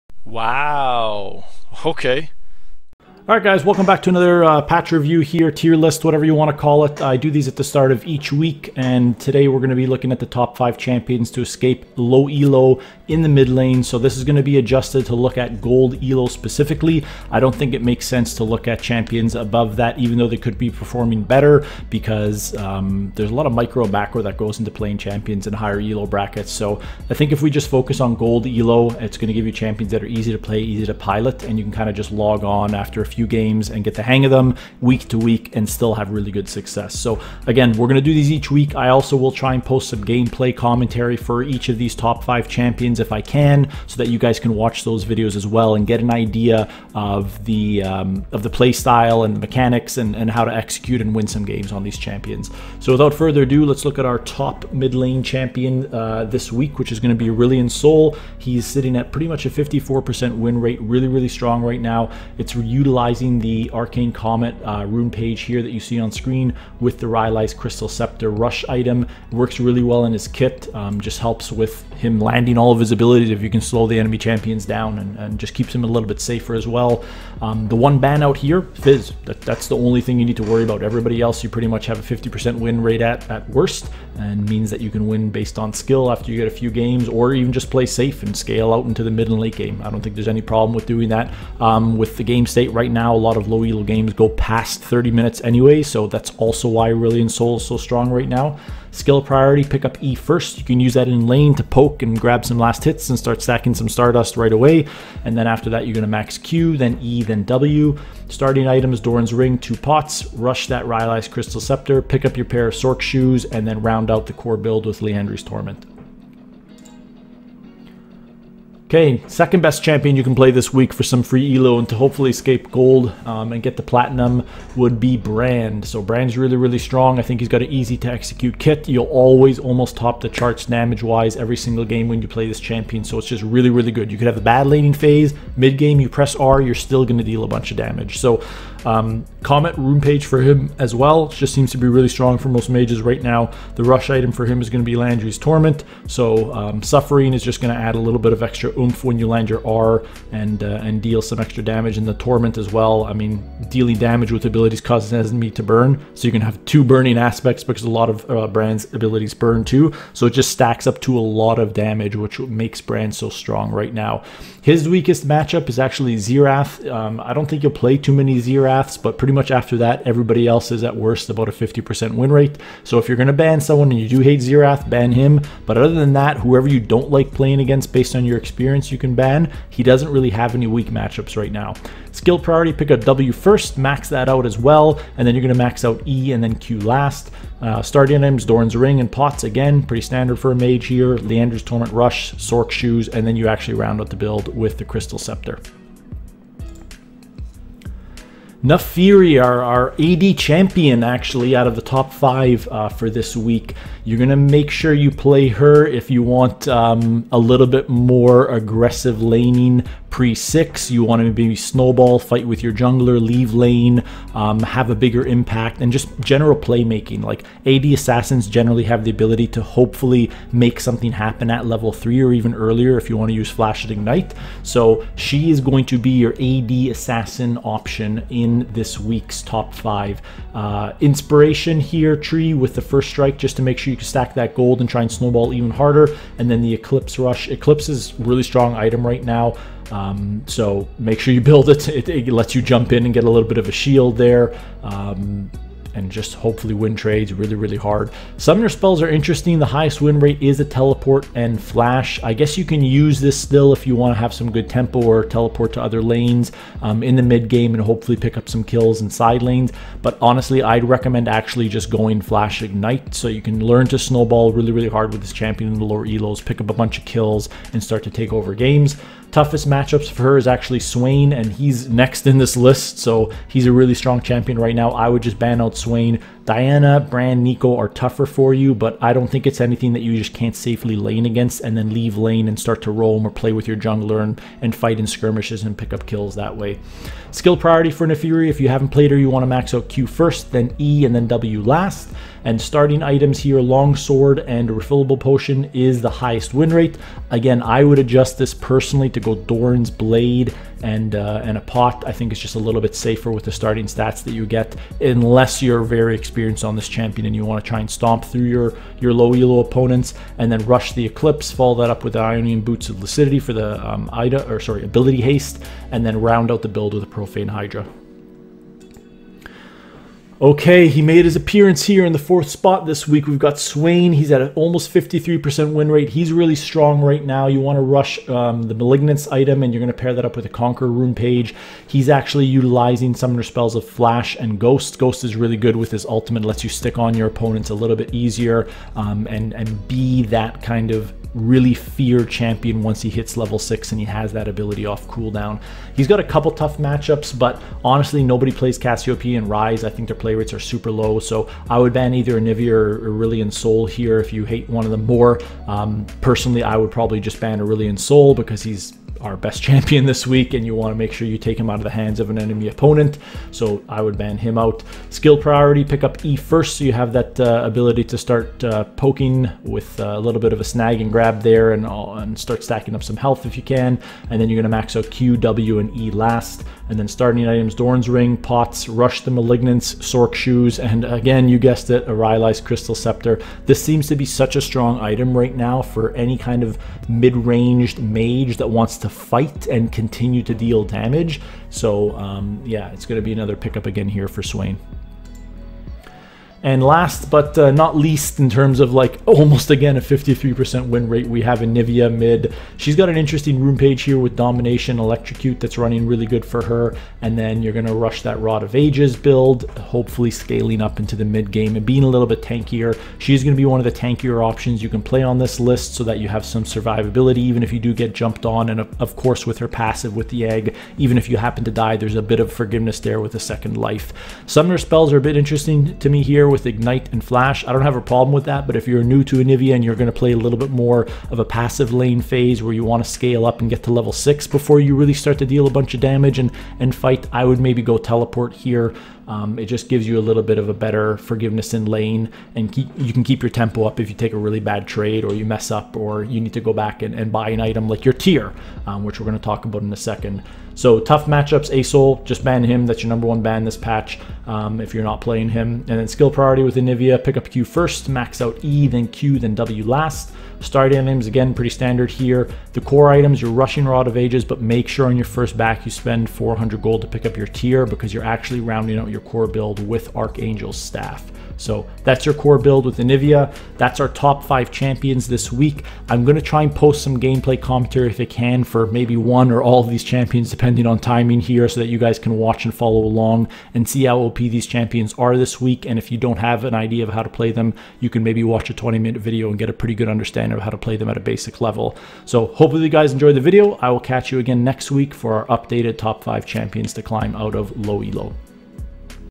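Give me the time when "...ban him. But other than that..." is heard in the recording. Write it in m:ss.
2:54.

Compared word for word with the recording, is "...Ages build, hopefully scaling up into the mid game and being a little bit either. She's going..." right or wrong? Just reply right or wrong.
wrong.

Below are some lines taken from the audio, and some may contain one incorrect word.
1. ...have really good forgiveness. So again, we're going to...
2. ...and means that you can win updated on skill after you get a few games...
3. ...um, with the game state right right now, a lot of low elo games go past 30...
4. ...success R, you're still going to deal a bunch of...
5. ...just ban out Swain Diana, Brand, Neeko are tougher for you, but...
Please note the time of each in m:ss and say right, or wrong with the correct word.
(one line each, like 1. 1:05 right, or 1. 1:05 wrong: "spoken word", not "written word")
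1. 0:35 wrong: "success", not "forgiveness"
2. 1:24 wrong: "based", not "updated"
3. 1:31 right
4. 2:16 wrong: "press", not "success"
5. 4:35 right.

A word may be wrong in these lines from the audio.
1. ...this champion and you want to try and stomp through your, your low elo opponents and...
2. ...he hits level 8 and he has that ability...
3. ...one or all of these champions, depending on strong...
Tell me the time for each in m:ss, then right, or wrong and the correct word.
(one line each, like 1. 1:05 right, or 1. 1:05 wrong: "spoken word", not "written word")
1. 5:06 right
2. 5:43 wrong: "6", not "8"
3. 7:59 wrong: "timing", not "strong".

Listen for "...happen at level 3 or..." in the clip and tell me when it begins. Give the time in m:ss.
3:41.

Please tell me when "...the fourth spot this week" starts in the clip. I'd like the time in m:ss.
5:22.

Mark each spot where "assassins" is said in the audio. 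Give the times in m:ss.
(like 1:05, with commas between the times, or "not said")
3:37, 3:46.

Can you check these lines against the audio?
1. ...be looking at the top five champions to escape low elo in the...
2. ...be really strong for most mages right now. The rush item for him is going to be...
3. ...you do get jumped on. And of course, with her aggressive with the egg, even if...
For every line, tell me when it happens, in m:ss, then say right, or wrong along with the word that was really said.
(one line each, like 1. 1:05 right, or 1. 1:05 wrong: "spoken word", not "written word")
1. 0:09 right
2. 2:21 right
3. 6:57 wrong: "passive", not "aggressive".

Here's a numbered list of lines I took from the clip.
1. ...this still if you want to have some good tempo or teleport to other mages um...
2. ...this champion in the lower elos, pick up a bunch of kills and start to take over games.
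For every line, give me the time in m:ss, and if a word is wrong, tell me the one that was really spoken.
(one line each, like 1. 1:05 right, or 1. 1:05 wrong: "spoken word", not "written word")
1. 4:13 wrong: "lanes", not "mages"
2. 4:25 right.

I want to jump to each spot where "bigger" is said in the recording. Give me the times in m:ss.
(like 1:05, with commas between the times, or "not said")
3:34.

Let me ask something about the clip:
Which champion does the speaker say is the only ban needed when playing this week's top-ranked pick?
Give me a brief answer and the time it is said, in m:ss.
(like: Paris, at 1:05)
Fizz, at 1:18.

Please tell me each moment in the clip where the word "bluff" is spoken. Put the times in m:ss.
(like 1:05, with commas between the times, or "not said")
not said.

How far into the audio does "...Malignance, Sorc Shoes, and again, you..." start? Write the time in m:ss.
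6:19.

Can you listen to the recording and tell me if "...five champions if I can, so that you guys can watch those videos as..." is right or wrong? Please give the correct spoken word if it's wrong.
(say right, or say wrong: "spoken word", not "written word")
right.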